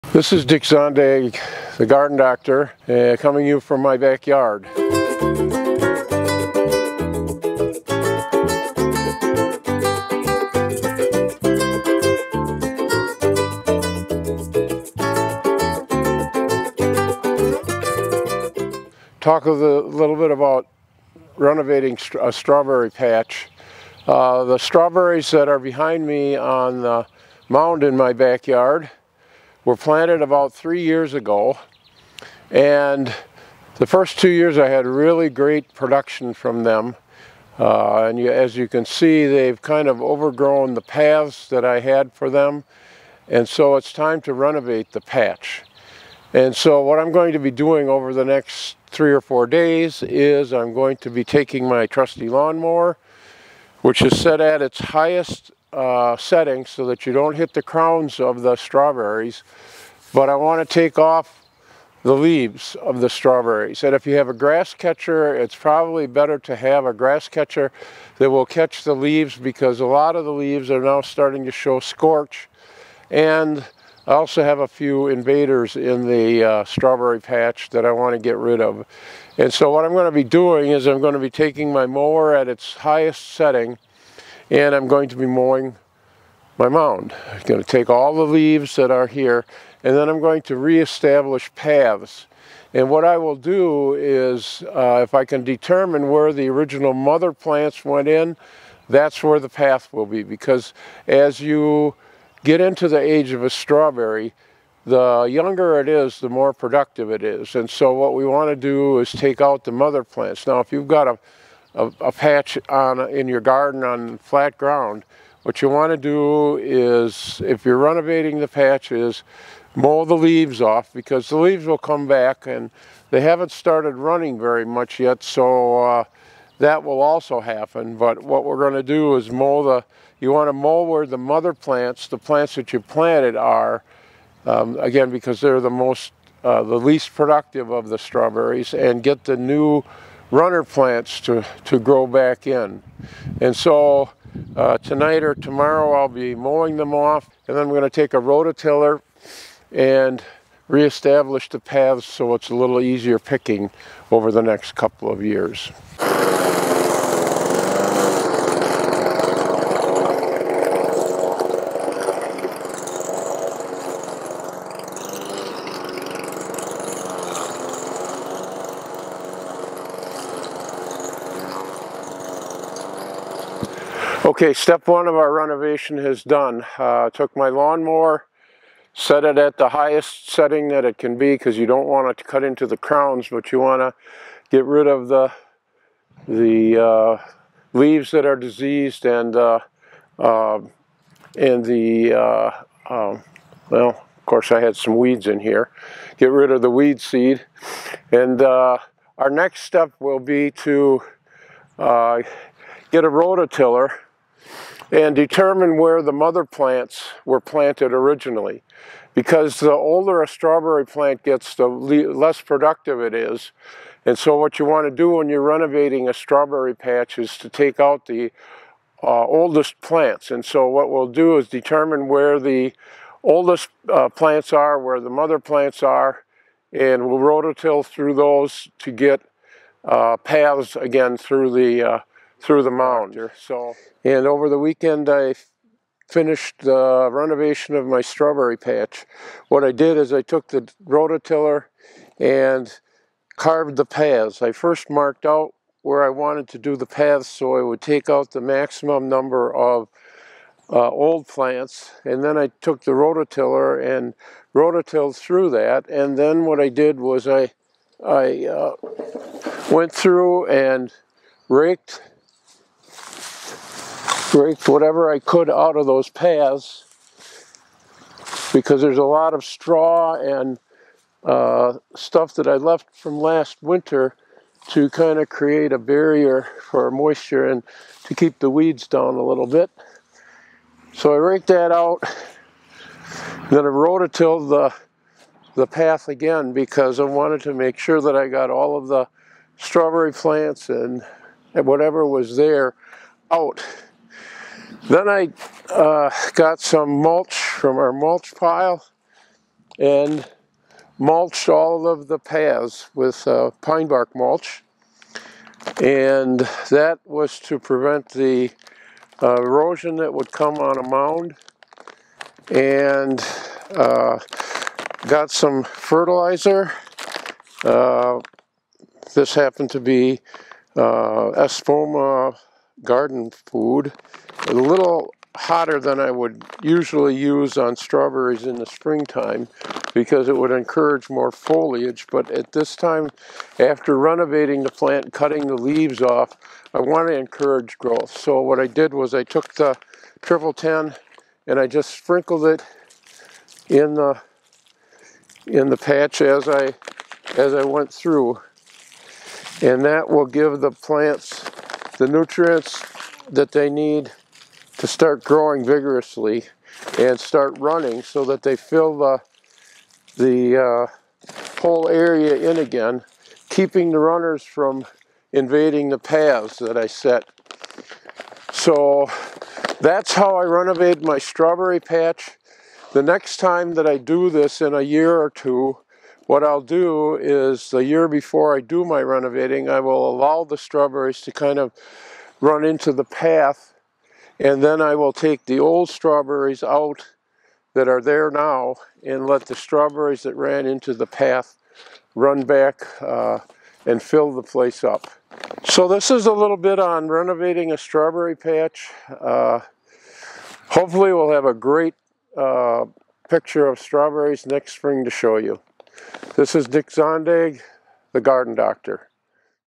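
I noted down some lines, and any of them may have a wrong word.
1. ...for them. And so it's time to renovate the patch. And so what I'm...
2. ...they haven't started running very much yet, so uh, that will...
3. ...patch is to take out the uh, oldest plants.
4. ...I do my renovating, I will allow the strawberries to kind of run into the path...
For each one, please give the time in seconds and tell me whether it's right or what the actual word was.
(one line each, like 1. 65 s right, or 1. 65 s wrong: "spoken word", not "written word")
1. 42 s right
2. 123 s right
3. 216 s right
4. 378 s right.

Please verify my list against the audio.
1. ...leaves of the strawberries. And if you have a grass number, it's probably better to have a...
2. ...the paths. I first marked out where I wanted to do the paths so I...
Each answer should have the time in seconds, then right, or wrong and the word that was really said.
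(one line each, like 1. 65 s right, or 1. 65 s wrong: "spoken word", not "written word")
1. 62 s wrong: "catcher", not "number"
2. 243 s right.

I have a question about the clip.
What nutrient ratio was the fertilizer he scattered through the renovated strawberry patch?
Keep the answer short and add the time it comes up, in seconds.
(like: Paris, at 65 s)
10-10-10 (triple 10), at 340 s.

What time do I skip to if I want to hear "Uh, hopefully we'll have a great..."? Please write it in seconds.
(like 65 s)
399 s.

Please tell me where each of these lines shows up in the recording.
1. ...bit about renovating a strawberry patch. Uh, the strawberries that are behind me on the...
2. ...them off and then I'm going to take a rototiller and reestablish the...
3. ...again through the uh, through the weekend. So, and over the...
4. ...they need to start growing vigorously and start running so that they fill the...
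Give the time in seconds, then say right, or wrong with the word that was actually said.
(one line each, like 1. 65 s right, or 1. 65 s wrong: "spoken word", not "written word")
1. 20 s right
2. 146 s right
3. 230 s wrong: "mound", not "weekend"
4. 353 s right.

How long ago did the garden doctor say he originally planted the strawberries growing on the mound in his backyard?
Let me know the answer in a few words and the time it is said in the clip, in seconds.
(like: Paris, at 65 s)
3 years, at 30 s.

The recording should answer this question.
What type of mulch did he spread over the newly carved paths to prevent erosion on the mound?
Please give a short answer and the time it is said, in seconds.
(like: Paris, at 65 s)
pine bark mulch, at 303 s.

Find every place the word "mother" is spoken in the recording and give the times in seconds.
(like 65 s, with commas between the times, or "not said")
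96 s, 109 s, 131 s, 206 s, 225 s.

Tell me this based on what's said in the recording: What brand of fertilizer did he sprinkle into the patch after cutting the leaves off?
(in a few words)
Espoma garden food.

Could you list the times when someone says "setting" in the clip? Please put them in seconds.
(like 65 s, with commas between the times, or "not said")
56 s, 83 s, 180 s.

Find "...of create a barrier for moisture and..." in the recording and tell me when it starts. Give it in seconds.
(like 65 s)
275 s.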